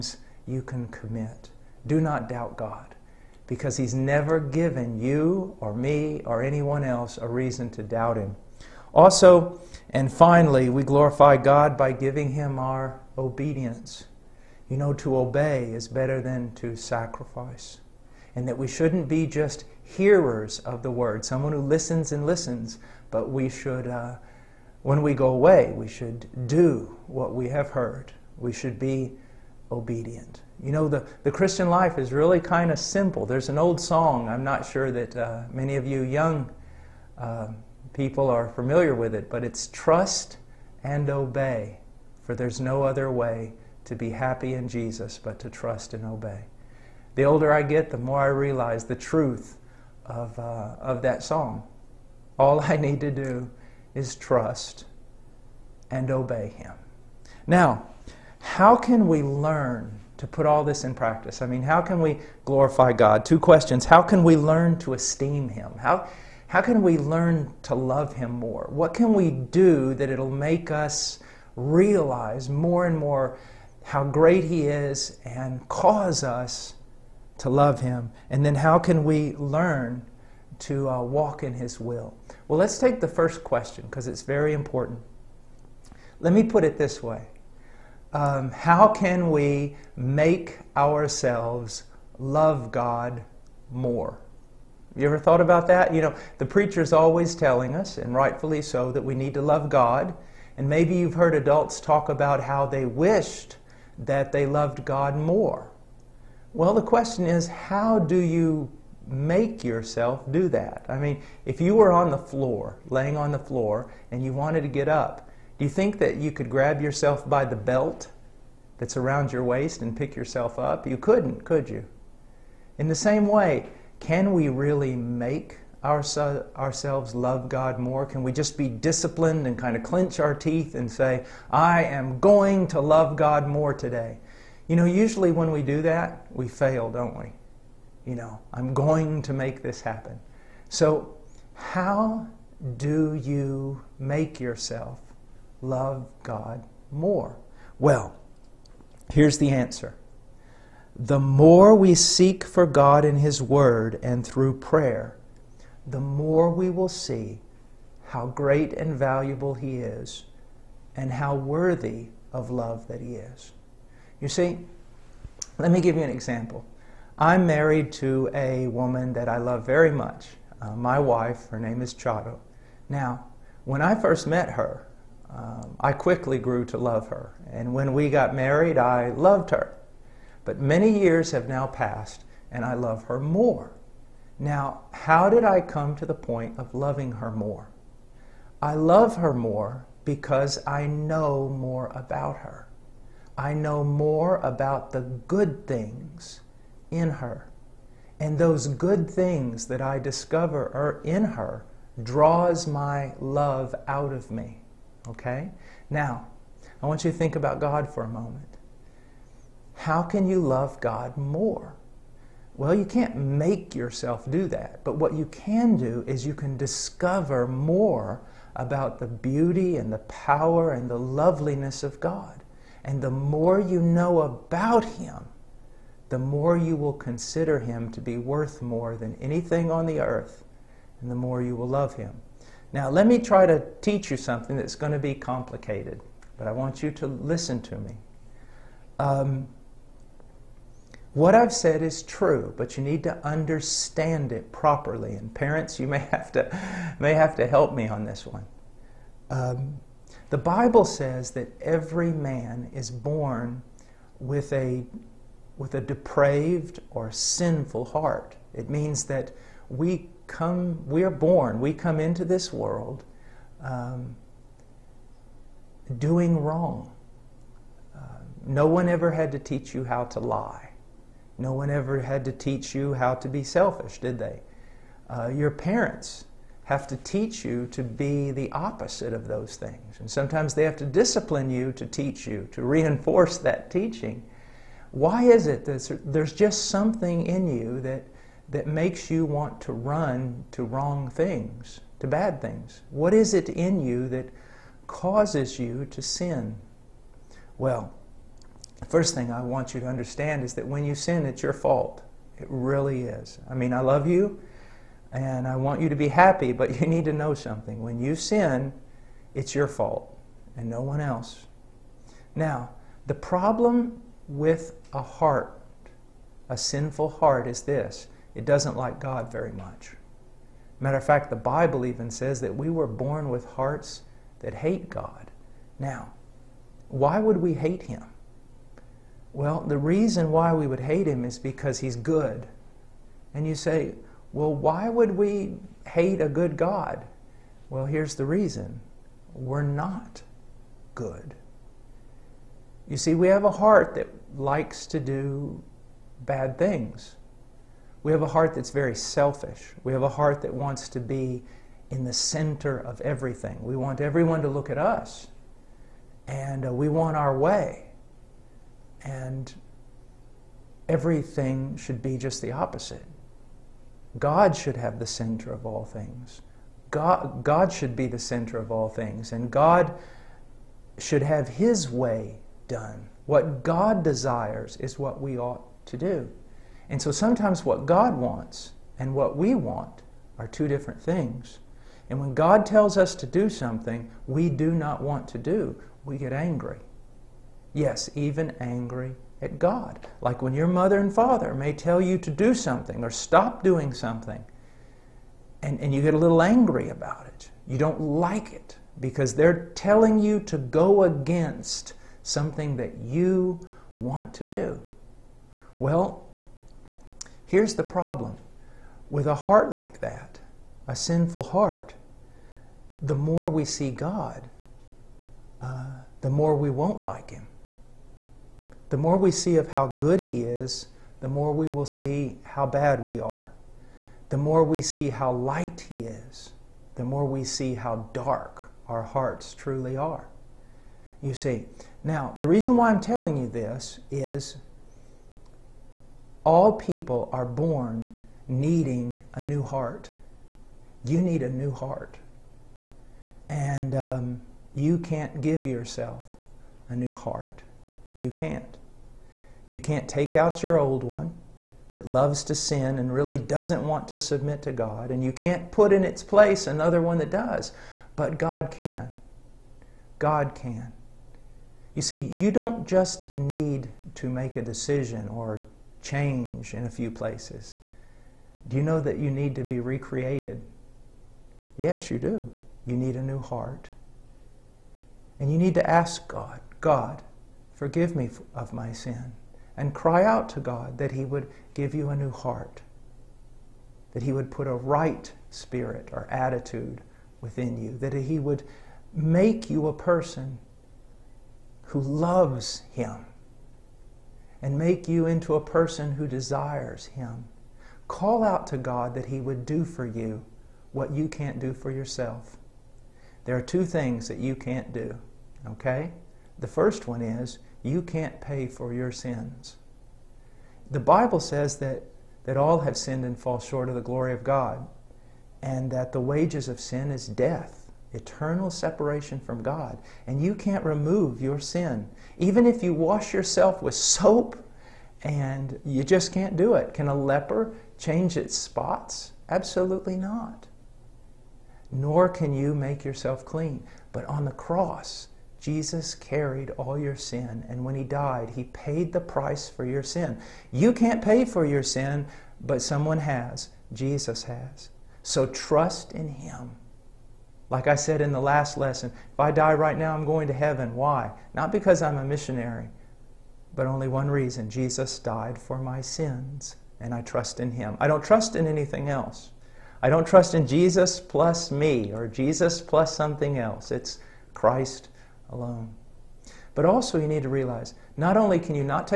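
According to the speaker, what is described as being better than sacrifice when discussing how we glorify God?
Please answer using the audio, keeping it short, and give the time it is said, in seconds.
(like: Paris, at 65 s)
To obey, at 14 s.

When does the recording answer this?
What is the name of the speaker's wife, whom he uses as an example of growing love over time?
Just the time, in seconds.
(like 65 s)
171 s.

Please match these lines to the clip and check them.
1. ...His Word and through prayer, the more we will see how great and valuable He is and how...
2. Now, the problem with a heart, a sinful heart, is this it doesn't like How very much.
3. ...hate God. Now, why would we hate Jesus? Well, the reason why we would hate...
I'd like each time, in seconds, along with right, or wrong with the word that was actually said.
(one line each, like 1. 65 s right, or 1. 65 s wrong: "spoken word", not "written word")
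1. 153 s right
2. 312 s wrong: "God", not "How"
3. 324 s wrong: "Him", not "Jesus".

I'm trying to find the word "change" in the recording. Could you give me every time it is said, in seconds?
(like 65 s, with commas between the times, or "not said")
466 s, 527 s.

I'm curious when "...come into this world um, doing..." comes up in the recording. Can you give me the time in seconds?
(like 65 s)
261 s.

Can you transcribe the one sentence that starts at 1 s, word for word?
Do not doubt God, because he's never given you or me or anyone else a reason to doubt him.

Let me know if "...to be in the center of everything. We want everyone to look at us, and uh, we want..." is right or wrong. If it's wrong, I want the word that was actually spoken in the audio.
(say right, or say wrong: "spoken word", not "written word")
right.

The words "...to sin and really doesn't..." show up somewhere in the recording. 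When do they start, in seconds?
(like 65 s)
452 s.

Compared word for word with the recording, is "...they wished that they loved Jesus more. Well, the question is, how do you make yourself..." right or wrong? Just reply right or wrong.
wrong.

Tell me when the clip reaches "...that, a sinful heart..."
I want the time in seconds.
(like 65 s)
409 s.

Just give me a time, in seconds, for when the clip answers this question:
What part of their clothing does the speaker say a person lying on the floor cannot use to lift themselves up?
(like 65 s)
117 s.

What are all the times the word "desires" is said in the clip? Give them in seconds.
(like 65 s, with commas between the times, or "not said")
374 s, 496 s.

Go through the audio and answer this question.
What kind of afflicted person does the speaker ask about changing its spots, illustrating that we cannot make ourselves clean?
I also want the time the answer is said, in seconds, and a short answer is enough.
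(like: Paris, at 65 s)
A leper, at 527 s.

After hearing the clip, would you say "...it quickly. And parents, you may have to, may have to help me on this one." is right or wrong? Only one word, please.
wrong.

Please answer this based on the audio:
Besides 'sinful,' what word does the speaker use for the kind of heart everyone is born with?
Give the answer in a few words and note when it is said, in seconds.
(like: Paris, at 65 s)
Depraved, at 255 s.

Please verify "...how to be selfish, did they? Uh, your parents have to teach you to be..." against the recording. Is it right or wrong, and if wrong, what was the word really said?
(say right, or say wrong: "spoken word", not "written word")
right.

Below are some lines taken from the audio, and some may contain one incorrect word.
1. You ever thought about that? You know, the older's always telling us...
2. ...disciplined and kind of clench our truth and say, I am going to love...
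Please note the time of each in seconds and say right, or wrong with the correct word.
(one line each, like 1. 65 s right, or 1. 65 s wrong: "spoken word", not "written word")
1. 94 s wrong: "preacher", not "older"
2. 128 s wrong: "teeth", not "truth".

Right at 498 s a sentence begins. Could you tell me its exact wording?
Call out to God that He would do for you what you can't do for yourself.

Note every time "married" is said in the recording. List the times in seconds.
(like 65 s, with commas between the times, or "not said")
167 s, 178 s.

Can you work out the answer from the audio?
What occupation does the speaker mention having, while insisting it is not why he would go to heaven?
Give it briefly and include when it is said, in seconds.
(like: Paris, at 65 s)
Missionary, at 552 s.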